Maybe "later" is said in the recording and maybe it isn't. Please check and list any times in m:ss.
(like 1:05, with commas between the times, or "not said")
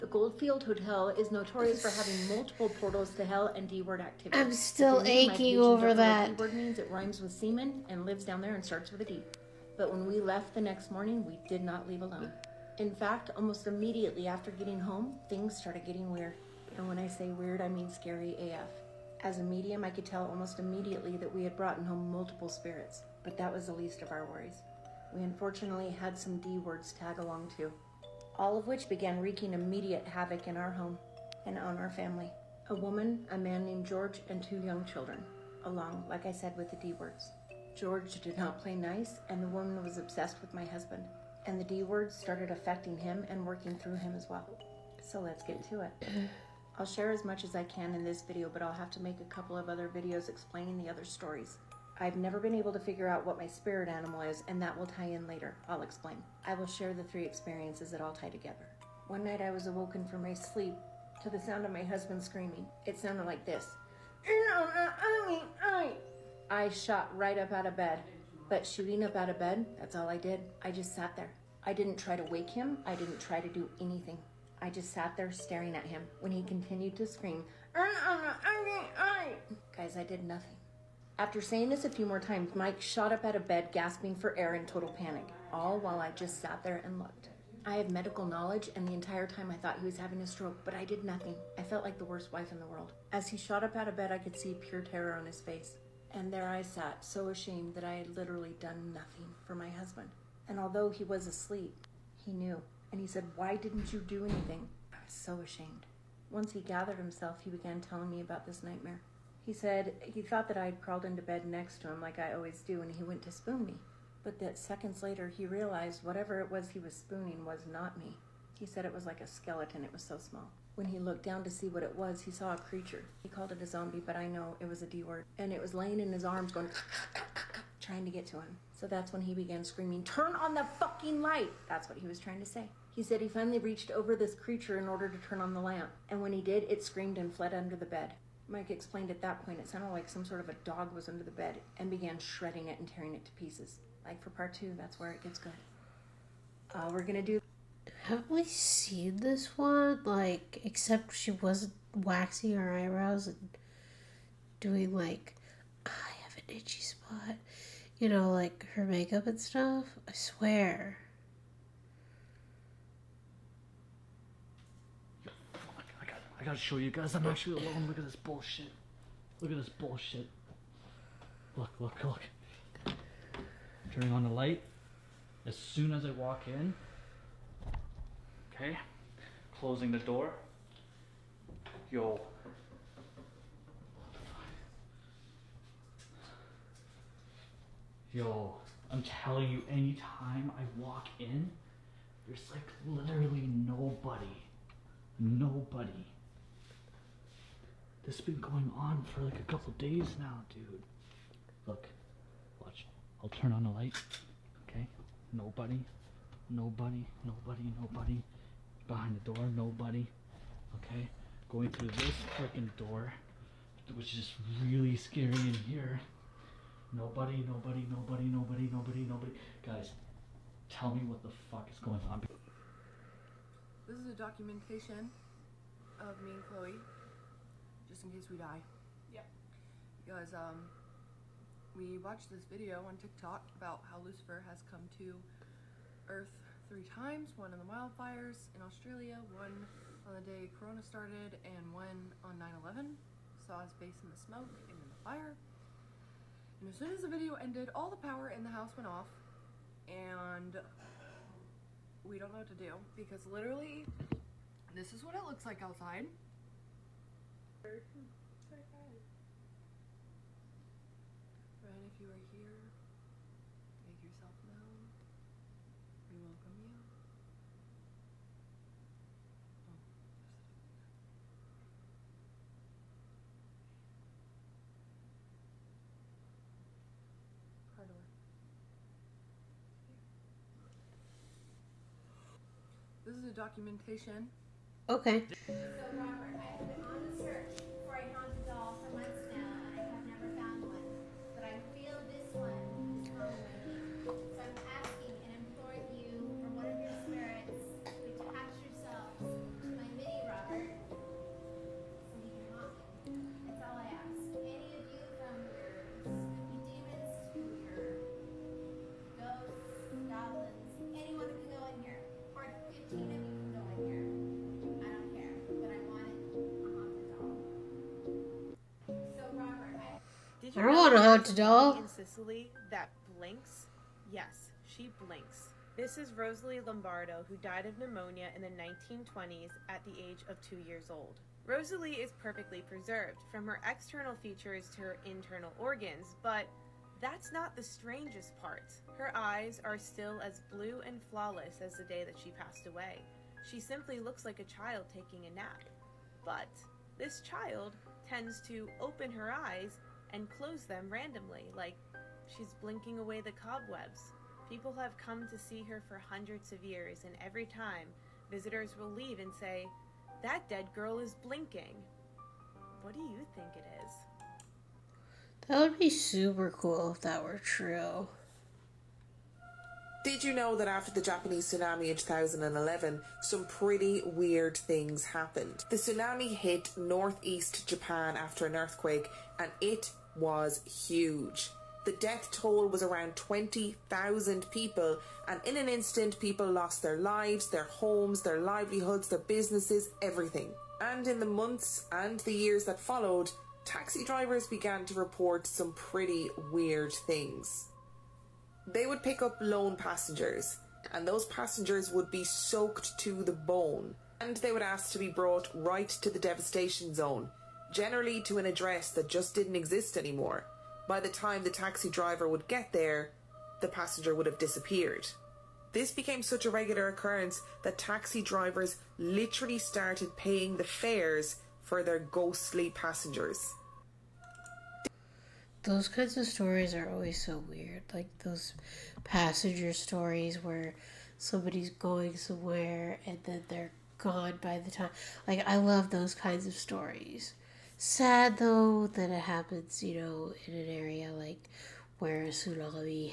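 0:55, 1:55.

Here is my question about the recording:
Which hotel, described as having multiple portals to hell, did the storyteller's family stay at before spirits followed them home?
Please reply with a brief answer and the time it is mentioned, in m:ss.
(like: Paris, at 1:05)
Goldfield Hotel, at 0:00.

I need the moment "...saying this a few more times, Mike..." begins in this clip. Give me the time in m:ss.
1:21.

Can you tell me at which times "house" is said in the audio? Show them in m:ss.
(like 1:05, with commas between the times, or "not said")
4:08.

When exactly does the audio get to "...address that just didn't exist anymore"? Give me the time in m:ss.
6:48.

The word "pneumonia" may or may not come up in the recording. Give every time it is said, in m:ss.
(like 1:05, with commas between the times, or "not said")
5:27.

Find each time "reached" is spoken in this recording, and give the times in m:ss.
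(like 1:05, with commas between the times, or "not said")
2:13.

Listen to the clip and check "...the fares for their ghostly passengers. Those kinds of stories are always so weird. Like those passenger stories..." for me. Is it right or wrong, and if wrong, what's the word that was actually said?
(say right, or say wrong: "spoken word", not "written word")
right.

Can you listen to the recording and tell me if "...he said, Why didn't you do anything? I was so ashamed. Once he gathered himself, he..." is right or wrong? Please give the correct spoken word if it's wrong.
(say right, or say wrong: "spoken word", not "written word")
right.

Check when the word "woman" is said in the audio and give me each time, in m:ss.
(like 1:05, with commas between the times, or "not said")
0:32, 0:39.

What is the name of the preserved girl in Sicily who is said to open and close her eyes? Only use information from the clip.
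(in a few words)
Rosalie Lombardo.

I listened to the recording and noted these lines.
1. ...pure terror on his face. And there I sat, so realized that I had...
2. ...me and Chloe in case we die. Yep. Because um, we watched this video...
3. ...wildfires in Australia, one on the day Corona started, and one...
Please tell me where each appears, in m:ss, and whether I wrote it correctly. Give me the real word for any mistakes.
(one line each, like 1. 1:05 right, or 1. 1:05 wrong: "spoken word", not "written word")
1. 1:34 wrong: "ashamed", not "realized"
2. 3:46 right
3. 3:57 right.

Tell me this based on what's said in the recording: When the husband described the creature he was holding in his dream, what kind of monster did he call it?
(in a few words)
zombie.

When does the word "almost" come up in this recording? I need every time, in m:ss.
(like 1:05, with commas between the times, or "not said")
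0:13, 0:20.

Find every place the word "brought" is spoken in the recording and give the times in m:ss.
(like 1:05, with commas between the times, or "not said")
0:21, 6:45.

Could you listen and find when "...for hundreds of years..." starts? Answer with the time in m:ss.
5:55.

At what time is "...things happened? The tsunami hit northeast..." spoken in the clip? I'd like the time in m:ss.
6:14.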